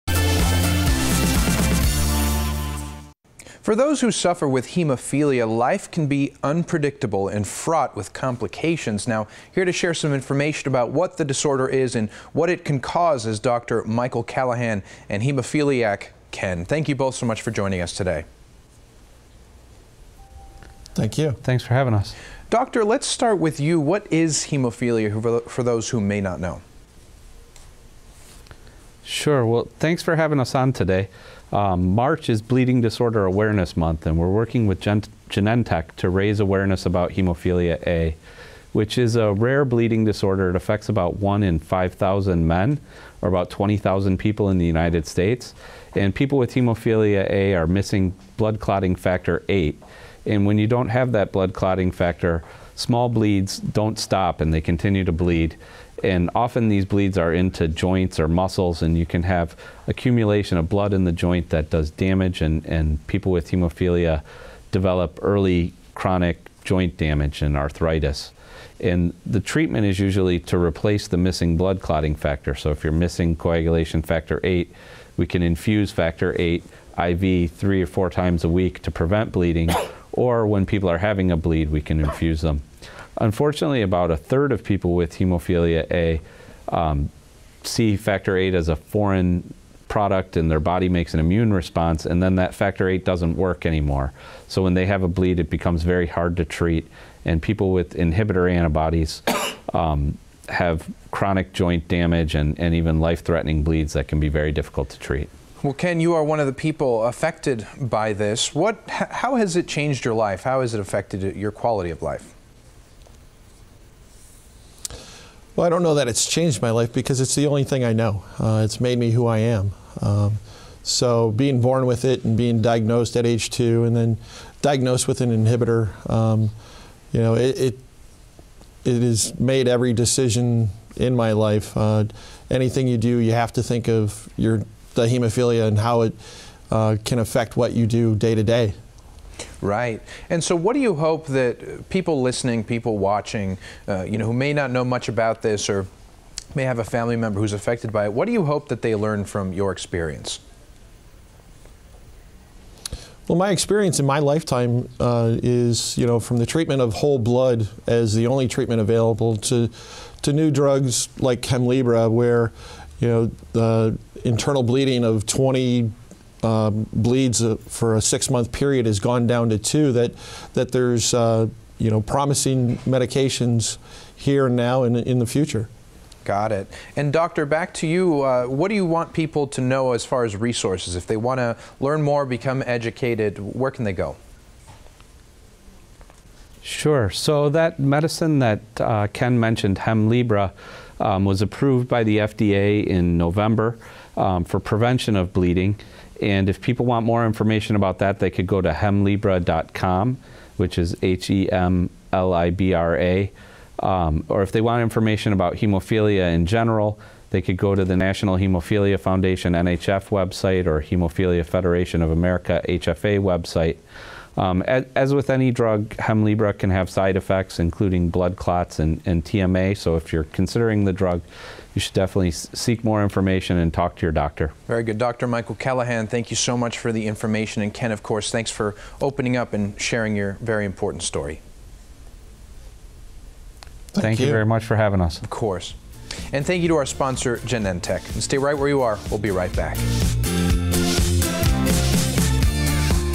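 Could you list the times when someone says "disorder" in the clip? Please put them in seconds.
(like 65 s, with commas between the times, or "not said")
11 s, 32 s, 40 s.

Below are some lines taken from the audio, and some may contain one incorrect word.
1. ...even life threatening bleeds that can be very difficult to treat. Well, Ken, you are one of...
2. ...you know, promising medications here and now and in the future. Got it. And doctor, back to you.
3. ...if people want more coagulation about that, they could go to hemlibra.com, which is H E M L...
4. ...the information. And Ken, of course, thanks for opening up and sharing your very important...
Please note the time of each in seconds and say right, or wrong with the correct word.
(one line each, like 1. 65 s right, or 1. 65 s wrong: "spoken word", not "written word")
1. 102 s right
2. 171 s right
3. 196 s wrong: "information", not "coagulation"
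4. 226 s right.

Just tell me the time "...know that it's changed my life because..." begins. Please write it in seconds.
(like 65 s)
115 s.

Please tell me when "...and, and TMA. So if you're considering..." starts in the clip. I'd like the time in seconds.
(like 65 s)
218 s.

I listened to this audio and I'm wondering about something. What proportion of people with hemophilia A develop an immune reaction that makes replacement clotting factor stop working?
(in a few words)
a third.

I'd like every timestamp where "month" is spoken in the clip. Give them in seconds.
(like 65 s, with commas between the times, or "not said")
33 s, 168 s.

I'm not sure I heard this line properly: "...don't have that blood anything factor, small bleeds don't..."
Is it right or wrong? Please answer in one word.
wrong.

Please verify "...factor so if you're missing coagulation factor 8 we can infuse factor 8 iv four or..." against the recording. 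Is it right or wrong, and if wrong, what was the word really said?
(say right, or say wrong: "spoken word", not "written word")
wrong: "three", not "four".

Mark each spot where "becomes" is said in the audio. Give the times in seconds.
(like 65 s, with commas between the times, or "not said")
95 s, 182 s.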